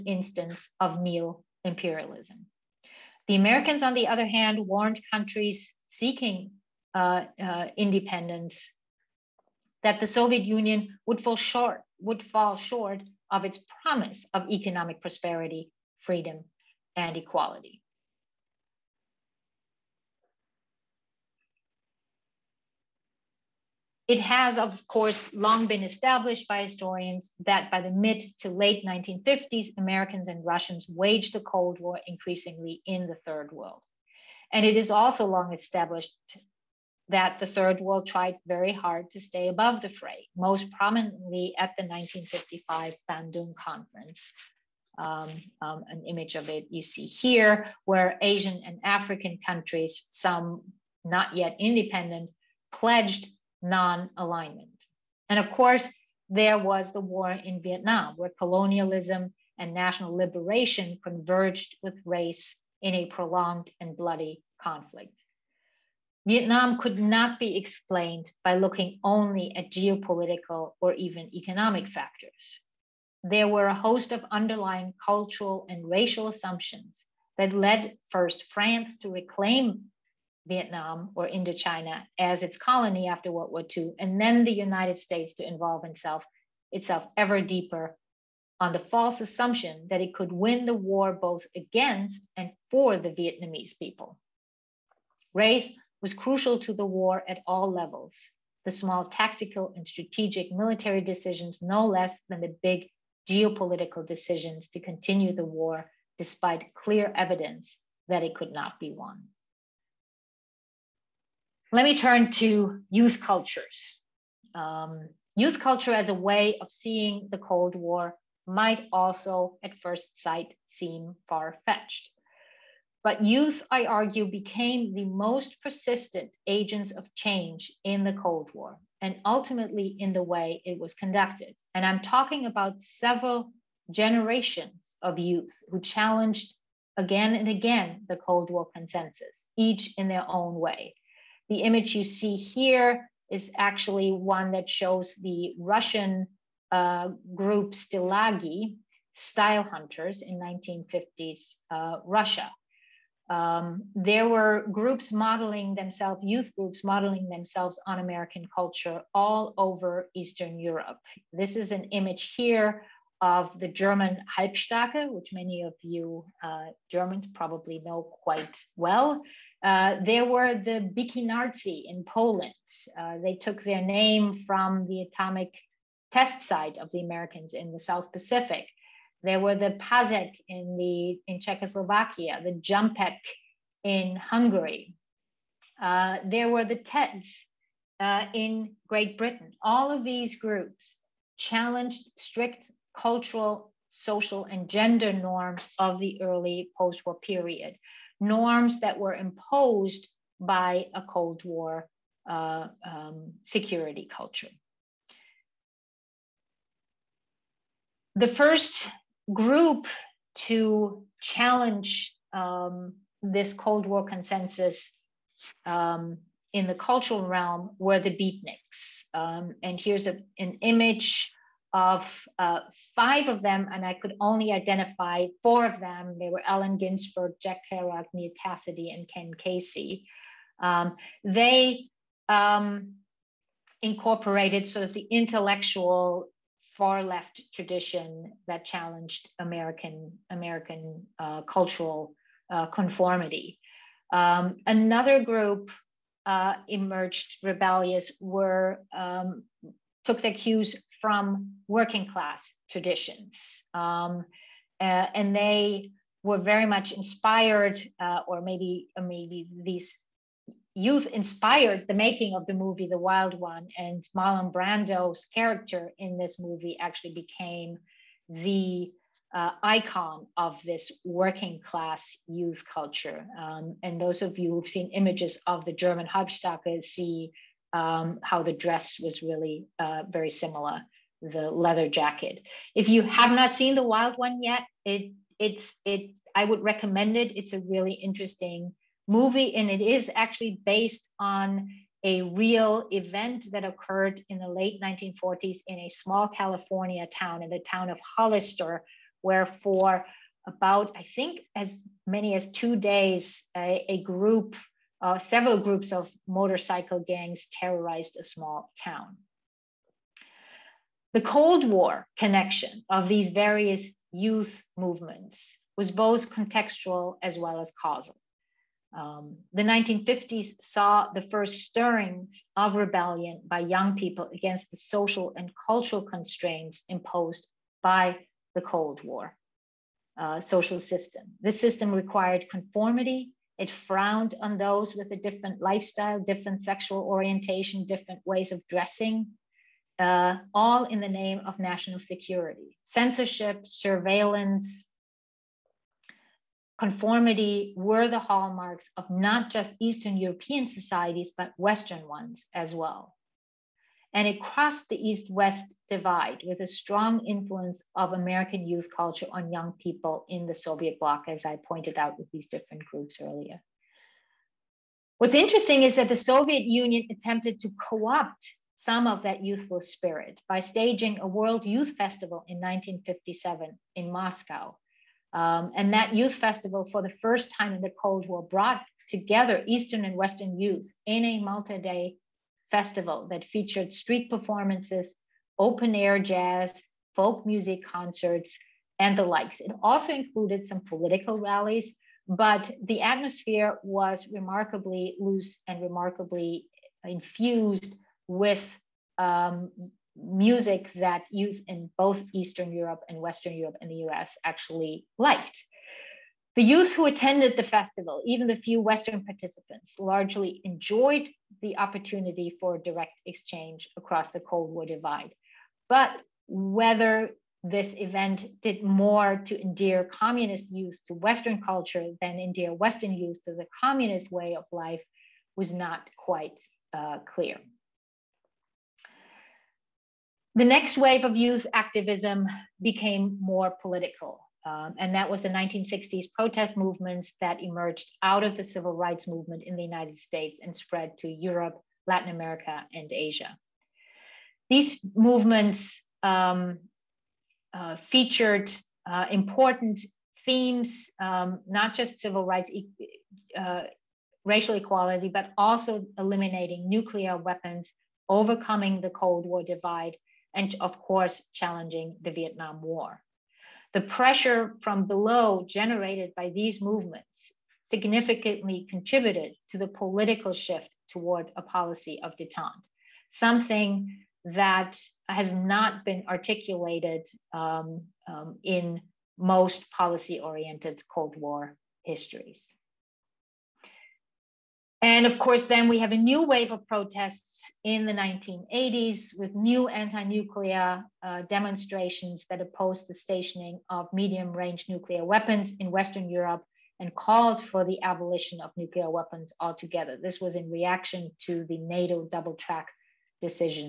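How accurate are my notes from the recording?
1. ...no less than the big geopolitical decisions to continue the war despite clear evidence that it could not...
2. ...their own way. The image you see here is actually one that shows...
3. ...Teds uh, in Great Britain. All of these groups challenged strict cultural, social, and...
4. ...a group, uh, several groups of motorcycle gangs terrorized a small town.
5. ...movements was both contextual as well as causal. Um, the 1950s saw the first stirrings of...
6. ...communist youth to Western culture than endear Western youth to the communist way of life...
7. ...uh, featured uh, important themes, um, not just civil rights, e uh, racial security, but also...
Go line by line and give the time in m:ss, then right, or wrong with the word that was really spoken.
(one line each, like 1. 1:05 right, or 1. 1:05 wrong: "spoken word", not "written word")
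1. 1:41 right
2. 2:20 right
3. 3:06 right
4. 5:03 right
5. 5:14 right
6. 7:00 right
7. 7:27 wrong: "equality", not "security".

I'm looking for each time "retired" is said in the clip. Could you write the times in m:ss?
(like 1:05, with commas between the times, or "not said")
not said.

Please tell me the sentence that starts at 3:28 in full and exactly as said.
The first group to challenge um, this Cold War consensus um, in the cultural realm were the beatniks.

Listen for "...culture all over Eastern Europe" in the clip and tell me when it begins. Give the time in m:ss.
2:38.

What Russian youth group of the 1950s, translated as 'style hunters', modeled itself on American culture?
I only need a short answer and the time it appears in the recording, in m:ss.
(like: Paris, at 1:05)
Stilagi, at 2:27.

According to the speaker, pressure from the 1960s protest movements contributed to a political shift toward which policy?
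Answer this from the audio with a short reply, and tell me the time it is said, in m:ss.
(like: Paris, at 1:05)
detente, at 7:52.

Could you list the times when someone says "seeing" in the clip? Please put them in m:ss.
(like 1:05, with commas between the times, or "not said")
1:56.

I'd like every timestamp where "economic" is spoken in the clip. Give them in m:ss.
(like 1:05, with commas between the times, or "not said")
0:14, 1:11.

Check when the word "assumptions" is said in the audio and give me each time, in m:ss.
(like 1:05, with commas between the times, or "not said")
1:16, 1:29.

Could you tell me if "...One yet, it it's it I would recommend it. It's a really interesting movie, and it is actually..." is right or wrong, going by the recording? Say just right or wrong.
right.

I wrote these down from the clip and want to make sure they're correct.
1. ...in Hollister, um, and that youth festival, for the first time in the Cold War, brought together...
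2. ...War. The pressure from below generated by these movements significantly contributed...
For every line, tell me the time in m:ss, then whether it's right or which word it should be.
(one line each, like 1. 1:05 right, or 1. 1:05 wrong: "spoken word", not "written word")
1. 6:13 wrong: "Moscow", not "Hollister"
2. 7:42 right.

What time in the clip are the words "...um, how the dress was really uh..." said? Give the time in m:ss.
4:37.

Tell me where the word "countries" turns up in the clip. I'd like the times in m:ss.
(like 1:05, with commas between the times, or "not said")
0:05, 0:49.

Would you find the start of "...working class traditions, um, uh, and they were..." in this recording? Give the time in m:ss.
4:11.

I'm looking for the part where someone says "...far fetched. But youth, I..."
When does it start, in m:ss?
2:01.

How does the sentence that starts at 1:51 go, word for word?
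Let me turn to youth cultures.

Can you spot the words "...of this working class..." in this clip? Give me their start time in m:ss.
4:30.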